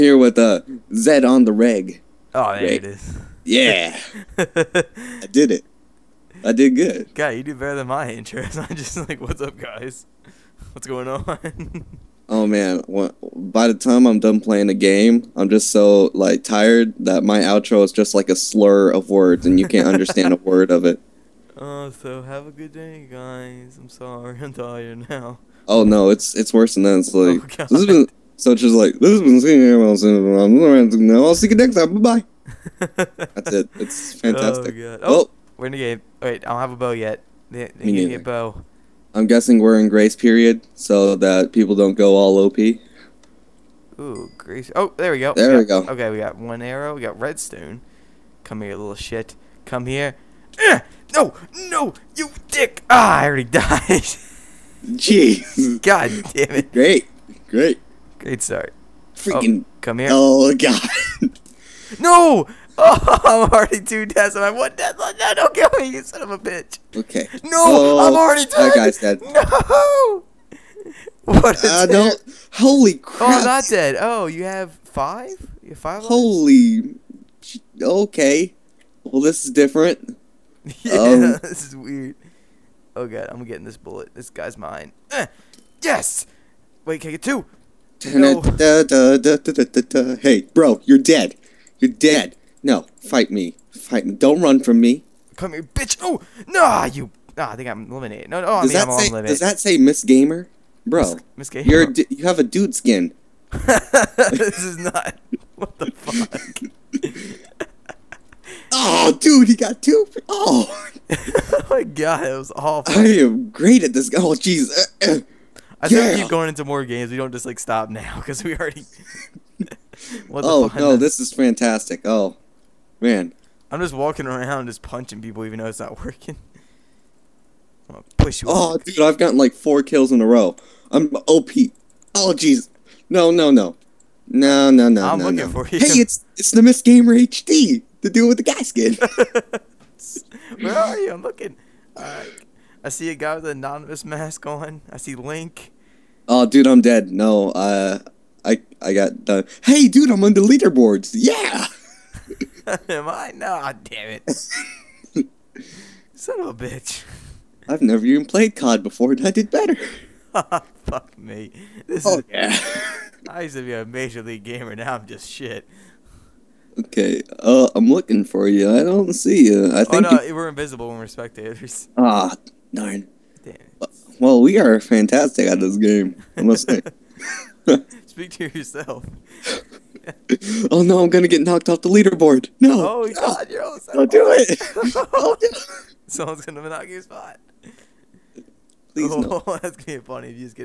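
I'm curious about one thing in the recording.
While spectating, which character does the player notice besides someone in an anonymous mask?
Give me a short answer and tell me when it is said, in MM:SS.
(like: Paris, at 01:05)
Link, at 02:25.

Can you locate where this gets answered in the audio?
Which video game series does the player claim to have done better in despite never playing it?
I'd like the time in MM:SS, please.
02:38.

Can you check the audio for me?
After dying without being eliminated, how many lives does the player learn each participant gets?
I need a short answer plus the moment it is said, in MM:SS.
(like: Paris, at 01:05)
5, at 01:14.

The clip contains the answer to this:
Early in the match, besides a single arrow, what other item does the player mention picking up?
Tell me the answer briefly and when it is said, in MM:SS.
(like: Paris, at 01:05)
Redstone, at 00:47.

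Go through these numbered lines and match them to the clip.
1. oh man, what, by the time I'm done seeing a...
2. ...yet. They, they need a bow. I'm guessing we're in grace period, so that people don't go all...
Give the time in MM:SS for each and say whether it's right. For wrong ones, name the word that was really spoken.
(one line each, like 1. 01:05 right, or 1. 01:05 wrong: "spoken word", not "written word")
1. 00:12 wrong: "playing", not "seeing"
2. 00:36 right.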